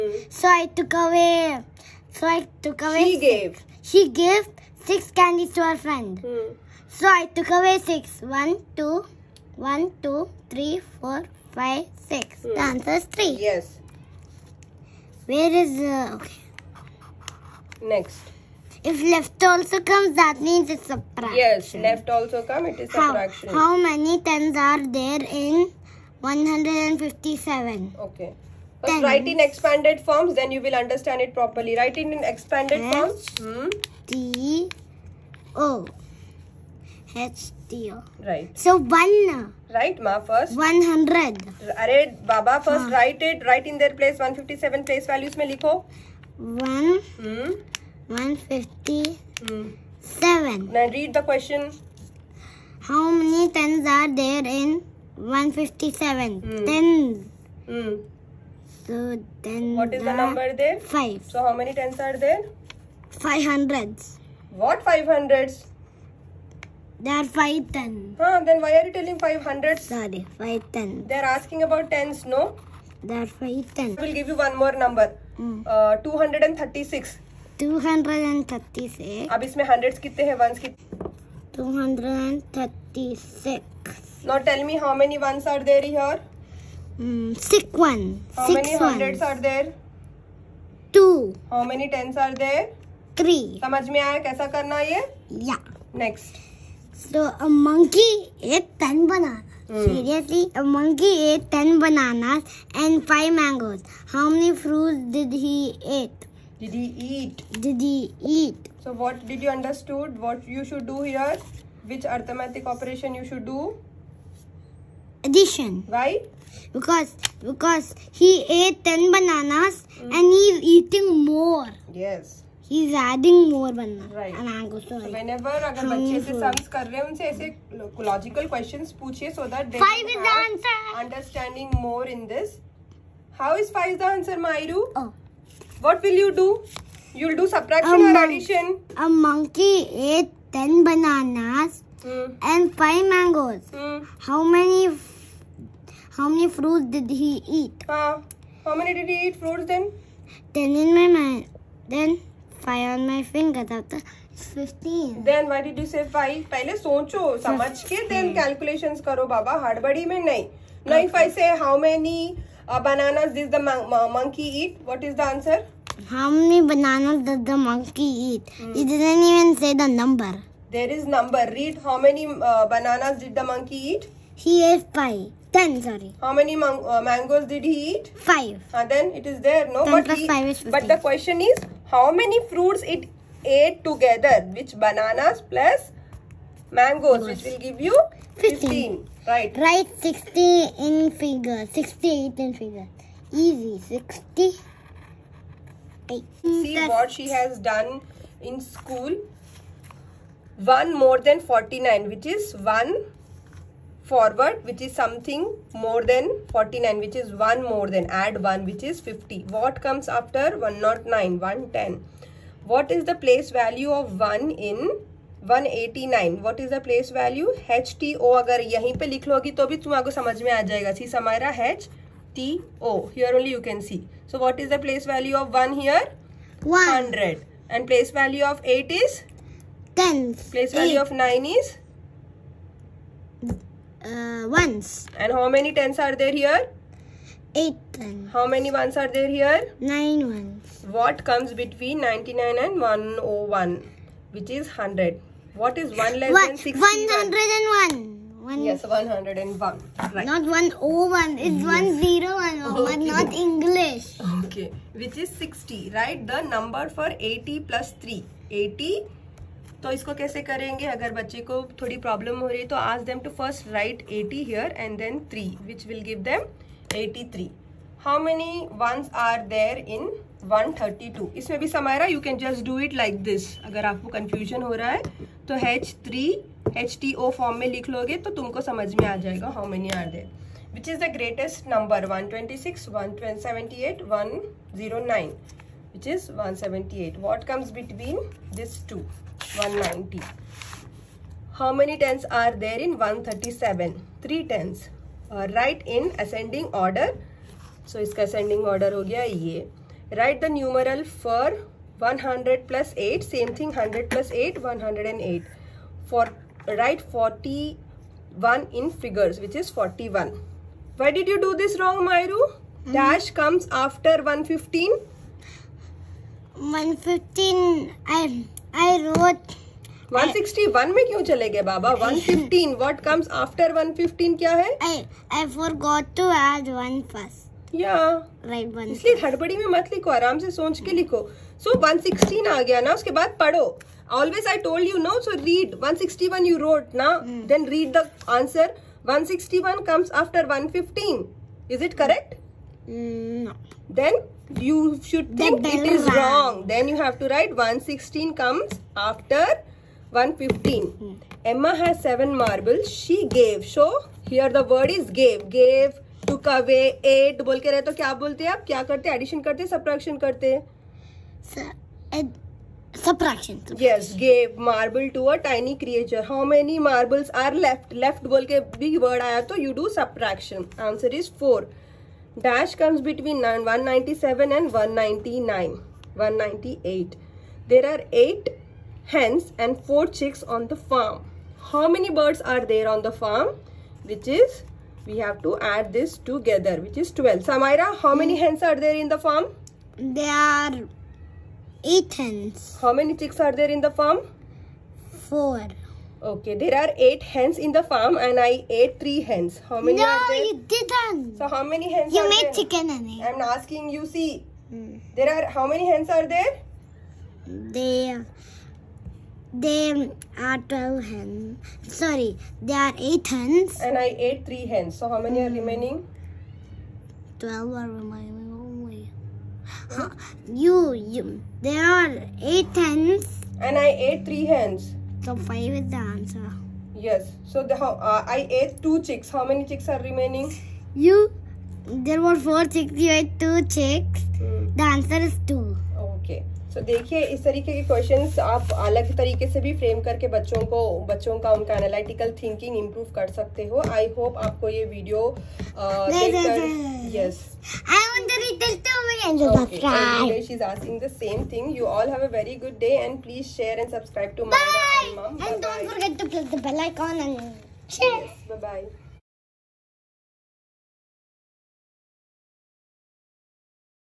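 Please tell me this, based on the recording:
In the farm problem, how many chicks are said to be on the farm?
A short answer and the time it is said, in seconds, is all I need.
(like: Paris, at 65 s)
4, at 379 s.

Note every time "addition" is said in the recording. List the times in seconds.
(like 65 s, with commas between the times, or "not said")
115 s, 359 s.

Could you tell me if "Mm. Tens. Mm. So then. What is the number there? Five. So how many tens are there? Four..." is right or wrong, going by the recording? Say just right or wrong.
wrong.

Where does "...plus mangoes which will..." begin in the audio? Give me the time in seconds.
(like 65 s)
185 s.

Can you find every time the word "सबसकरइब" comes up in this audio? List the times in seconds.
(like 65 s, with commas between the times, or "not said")
453 s.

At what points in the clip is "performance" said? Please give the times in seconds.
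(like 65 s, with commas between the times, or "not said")
not said.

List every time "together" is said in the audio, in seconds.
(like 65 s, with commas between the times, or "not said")
183 s, 386 s.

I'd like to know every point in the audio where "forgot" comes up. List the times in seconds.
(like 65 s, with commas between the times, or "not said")
325 s.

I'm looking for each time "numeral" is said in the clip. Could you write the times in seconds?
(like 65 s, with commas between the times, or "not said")
300 s.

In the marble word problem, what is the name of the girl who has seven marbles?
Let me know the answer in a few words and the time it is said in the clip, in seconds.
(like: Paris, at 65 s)
Emma, at 351 s.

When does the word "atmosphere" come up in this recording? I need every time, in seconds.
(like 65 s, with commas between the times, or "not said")
not said.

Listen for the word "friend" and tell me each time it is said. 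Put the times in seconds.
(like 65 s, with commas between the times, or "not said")
5 s.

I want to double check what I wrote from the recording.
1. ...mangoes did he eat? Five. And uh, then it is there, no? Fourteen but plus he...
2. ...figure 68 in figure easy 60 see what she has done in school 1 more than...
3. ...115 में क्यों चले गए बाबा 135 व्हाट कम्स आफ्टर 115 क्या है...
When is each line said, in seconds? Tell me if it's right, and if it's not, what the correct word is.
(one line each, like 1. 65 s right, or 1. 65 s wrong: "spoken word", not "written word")
1. 177 s wrong: "Ten", not "Fourteen"
2. 191 s right
3. 316 s wrong: "115", not "135".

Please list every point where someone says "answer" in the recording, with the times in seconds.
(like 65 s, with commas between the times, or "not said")
12 s, 165 s, 370 s, 425 s, 434 s.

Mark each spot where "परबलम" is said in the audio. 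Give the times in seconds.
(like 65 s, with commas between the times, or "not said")
262 s.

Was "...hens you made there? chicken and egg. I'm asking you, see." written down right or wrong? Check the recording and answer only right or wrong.
right.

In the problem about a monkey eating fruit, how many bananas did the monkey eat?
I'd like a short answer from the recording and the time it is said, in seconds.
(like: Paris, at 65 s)
10, at 100 s.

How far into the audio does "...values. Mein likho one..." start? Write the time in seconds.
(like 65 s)
45 s.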